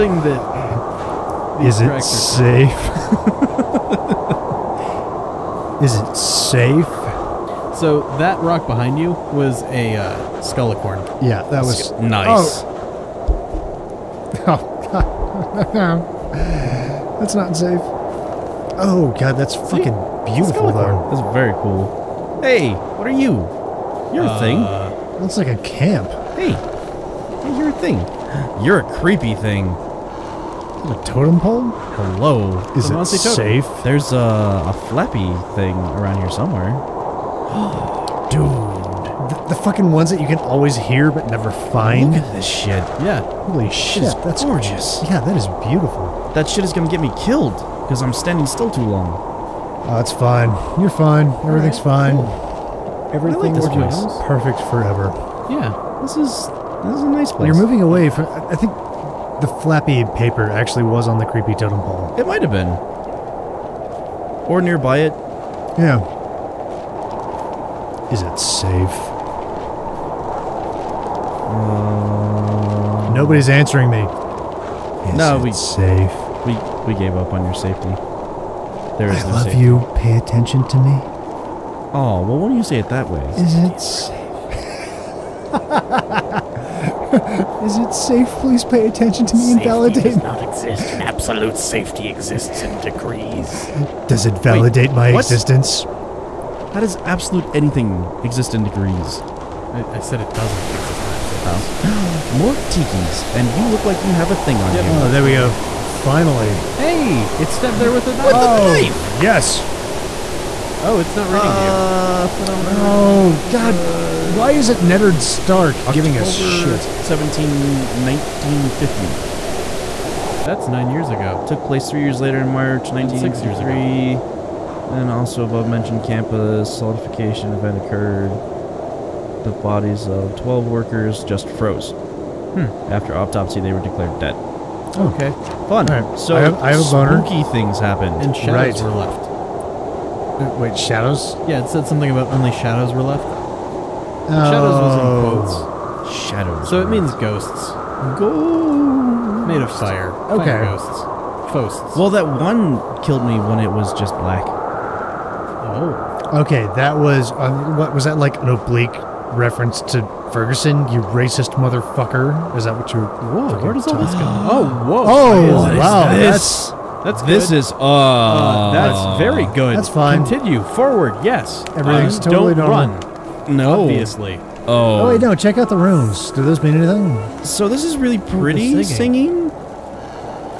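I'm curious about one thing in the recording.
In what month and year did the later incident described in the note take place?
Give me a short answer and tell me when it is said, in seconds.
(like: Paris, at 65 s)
March 1963, at 122 s.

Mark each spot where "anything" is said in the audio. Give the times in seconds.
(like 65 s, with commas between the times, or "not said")
97 s, 176 s.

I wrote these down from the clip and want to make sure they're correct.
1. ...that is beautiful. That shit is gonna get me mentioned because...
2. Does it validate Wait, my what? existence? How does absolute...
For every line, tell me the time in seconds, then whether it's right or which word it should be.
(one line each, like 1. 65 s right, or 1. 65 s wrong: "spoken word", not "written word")
1. 45 s wrong: "killed", not "mentioned"
2. 94 s right.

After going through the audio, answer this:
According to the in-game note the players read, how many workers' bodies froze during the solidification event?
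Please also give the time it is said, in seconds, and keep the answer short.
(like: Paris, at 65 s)
12, at 130 s.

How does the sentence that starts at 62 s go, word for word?
It might have been, or nearby it.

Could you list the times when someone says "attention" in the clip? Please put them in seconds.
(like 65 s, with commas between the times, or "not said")
80 s, 88 s.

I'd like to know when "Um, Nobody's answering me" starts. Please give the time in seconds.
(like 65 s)
71 s.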